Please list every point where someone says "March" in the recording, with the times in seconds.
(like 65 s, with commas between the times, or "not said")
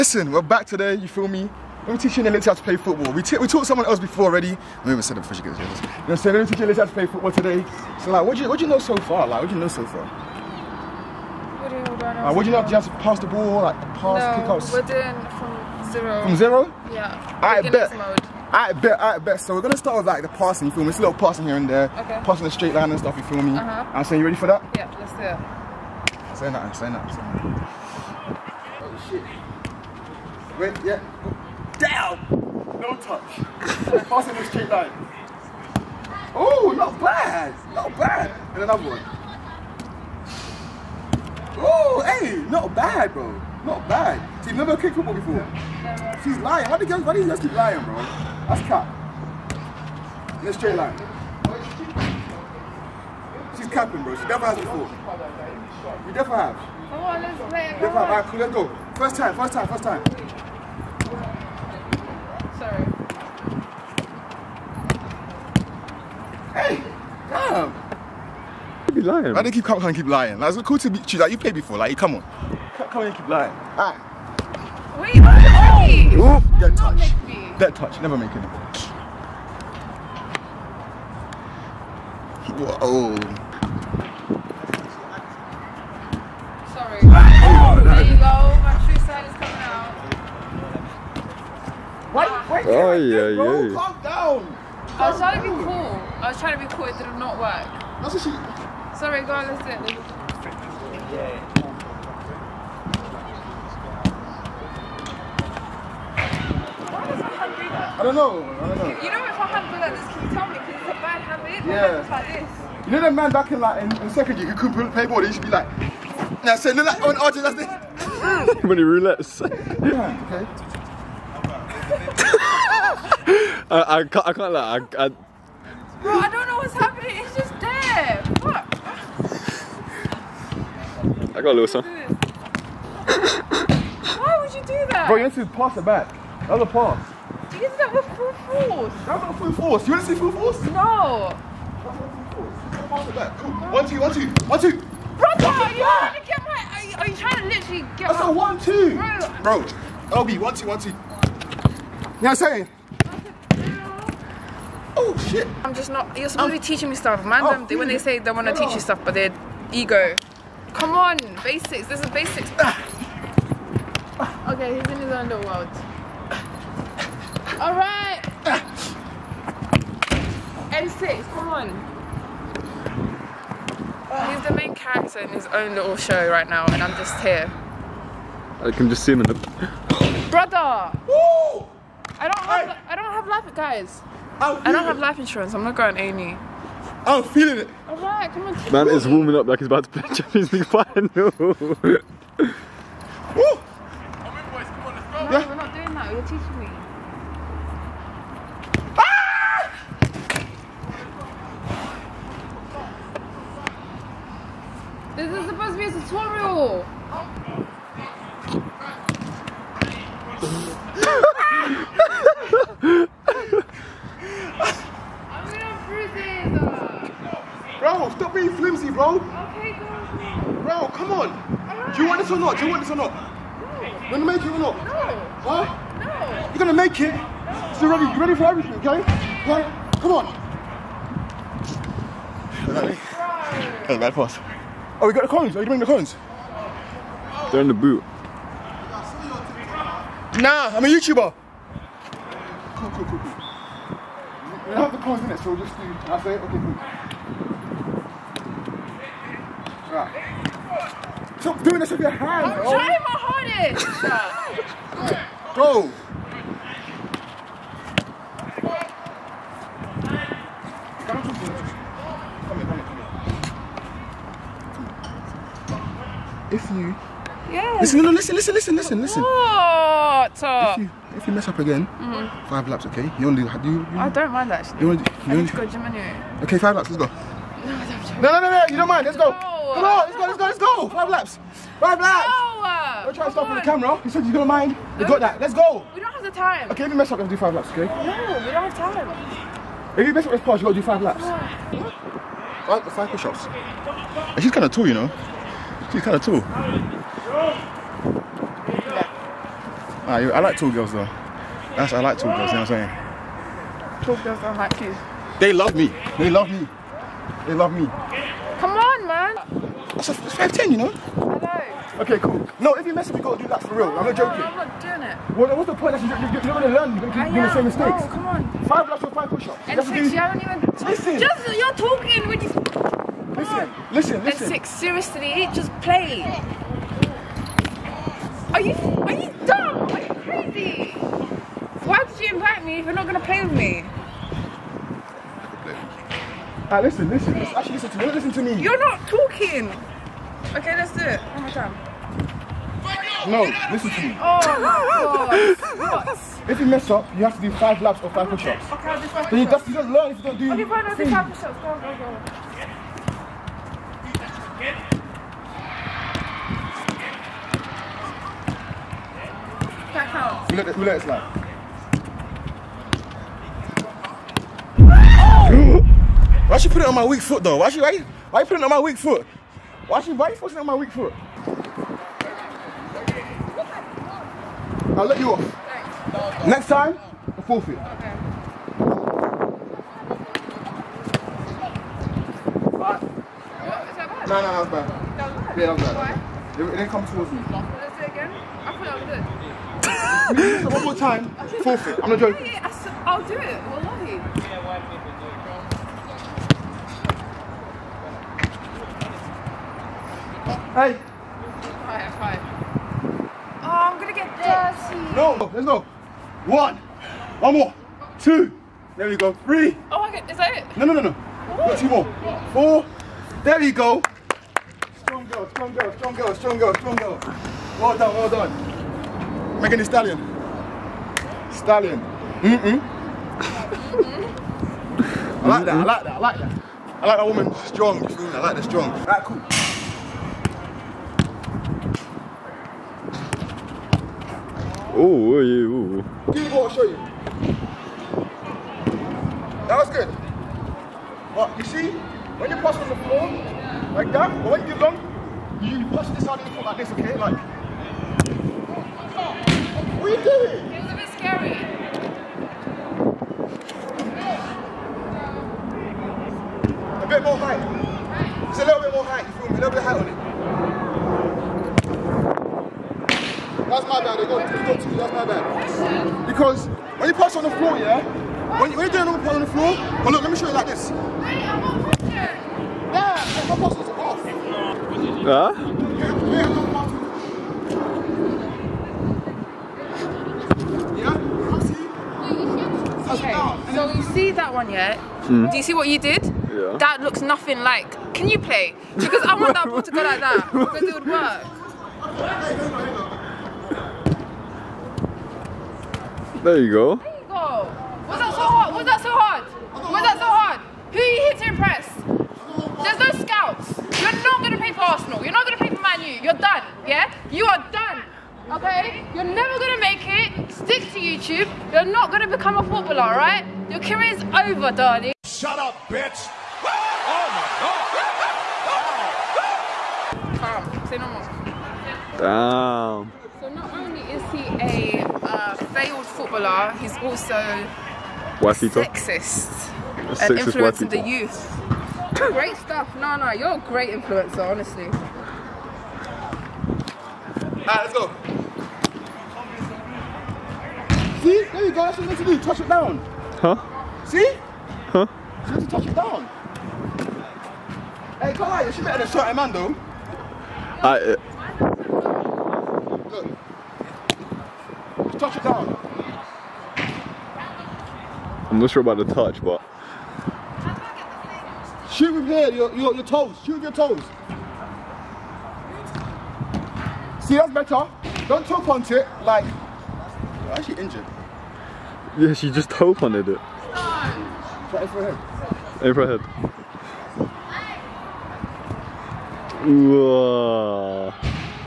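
not said.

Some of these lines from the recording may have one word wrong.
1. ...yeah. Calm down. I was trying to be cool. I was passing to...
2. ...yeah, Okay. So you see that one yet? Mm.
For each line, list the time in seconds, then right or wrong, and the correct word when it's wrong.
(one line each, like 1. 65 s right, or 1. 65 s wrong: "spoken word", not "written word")
1. 93 s wrong: "trying", not "passing"
2. 480 s right.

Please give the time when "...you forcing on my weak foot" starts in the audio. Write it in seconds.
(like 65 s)
370 s.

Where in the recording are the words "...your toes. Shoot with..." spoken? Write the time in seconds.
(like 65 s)
562 s.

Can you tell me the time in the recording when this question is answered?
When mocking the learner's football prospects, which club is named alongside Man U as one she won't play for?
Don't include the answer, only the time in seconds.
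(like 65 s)
504 s.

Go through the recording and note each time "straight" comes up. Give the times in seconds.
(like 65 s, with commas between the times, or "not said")
22 s, 34 s, 50 s.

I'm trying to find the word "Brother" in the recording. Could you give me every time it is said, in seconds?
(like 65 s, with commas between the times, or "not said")
145 s, 180 s.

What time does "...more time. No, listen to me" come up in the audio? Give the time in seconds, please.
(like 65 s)
341 s.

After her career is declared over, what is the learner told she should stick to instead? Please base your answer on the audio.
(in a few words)
YouTube.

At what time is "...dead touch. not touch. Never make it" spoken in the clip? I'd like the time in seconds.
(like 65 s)
76 s.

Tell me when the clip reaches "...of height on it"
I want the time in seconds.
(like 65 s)
459 s.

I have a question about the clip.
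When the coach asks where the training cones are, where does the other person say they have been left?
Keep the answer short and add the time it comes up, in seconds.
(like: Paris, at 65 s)
In the boot, at 237 s.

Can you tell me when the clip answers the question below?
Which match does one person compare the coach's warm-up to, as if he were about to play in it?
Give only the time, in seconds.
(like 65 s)
190 s.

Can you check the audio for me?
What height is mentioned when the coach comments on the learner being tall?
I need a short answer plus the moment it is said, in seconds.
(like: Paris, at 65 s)
5'10, at 310 s.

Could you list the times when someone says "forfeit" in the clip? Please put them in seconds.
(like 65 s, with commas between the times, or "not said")
377 s, 391 s.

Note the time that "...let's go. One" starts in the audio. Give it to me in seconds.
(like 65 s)
405 s.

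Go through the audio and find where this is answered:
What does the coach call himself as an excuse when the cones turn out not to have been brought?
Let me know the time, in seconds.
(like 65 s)
240 s.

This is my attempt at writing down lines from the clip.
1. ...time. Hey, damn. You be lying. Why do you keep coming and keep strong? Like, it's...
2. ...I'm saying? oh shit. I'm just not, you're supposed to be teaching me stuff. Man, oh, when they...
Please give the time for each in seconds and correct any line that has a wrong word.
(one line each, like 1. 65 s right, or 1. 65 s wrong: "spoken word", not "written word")
1. 59 s wrong: "lying", not "strong"
2. 152 s right.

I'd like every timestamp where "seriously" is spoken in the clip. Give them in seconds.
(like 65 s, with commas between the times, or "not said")
324 s.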